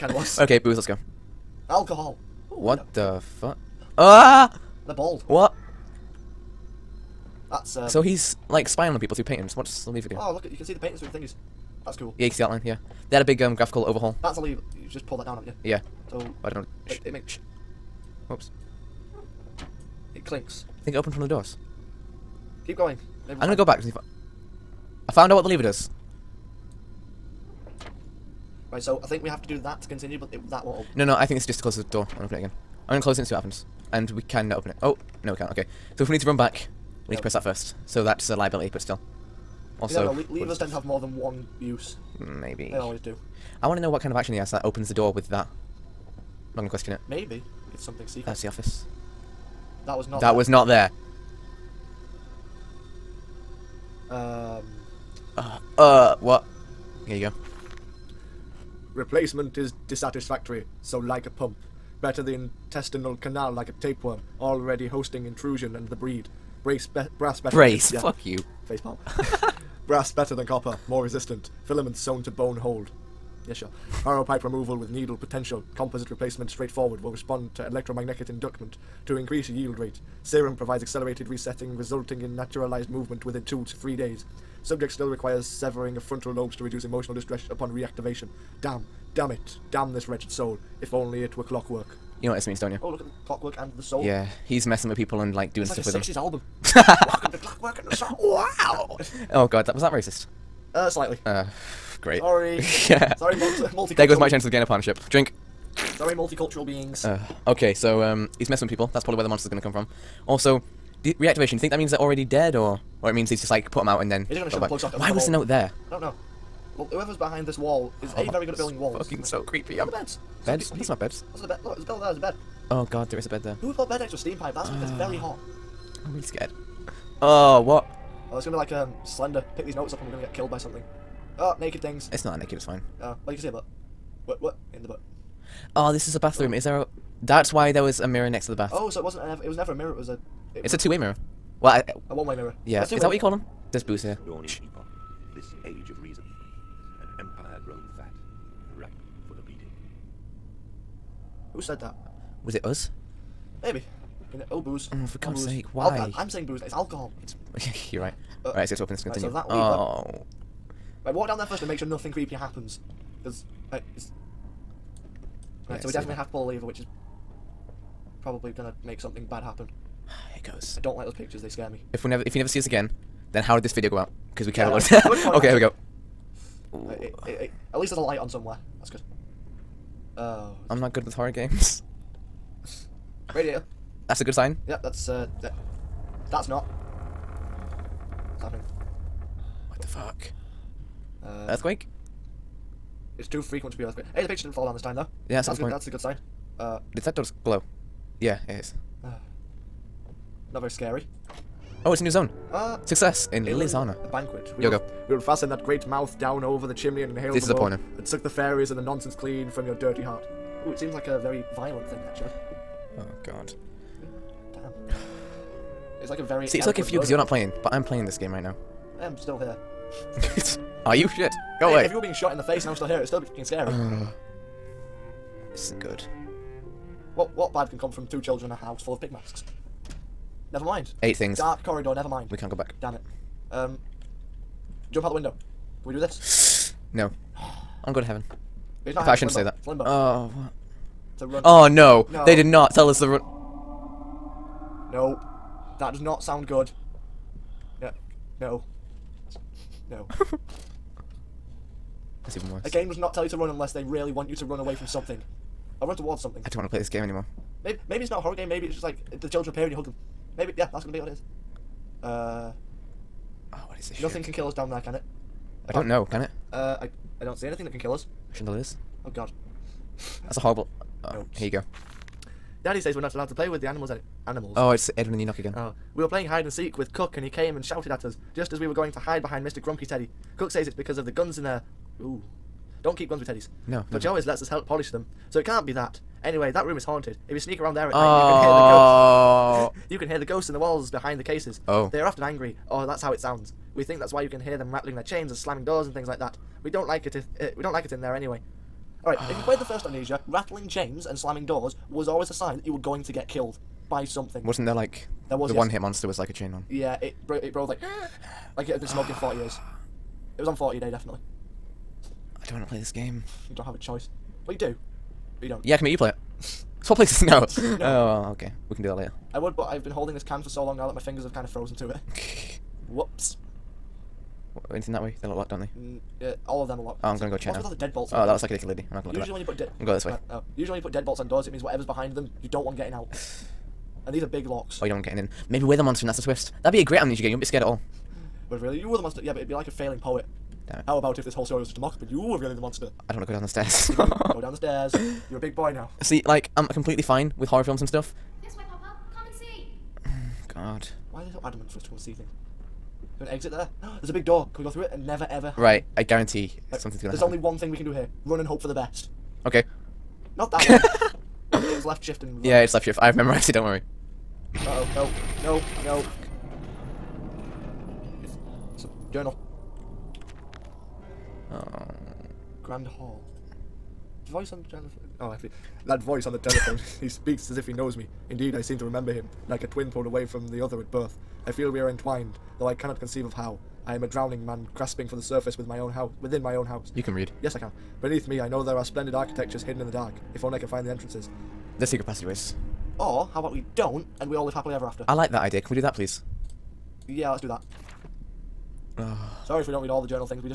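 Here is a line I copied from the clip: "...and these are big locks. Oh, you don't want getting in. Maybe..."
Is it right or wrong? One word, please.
right.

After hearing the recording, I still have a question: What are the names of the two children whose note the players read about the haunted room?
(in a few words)
Edwin and Enoch.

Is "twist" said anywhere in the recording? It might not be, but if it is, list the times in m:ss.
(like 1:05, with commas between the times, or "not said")
5:36.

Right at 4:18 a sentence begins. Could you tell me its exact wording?
Maybe it's just like the children appear and you hug them.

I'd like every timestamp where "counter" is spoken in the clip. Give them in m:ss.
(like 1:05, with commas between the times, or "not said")
not said.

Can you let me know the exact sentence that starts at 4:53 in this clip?
We think that's why you can hear them rattling their chains and slamming doors and things like that.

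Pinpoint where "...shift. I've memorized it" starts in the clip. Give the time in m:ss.
6:02.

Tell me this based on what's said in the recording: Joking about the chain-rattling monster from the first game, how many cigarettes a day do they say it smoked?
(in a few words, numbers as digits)
40.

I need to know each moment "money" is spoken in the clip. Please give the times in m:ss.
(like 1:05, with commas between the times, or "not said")
not said.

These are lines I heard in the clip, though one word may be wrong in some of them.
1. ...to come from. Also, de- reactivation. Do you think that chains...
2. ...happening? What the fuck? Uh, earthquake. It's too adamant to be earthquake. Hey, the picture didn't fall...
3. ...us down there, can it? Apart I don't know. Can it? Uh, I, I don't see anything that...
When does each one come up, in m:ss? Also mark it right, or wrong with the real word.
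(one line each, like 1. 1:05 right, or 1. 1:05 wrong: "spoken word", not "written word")
1. 1:49 wrong: "means", not "chains"
2. 3:08 wrong: "frequent", not "adamant"
3. 4:24 right.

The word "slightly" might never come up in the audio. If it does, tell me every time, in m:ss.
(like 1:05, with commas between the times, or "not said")
1:40.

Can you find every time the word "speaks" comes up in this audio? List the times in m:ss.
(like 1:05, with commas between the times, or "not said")
6:17.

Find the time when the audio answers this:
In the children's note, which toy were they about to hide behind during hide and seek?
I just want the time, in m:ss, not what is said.
4:39.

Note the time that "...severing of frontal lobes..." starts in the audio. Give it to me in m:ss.
1:25.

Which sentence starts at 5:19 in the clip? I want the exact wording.
I would, but I've been holding this can for so long now that my fingers have kind of frozen to it.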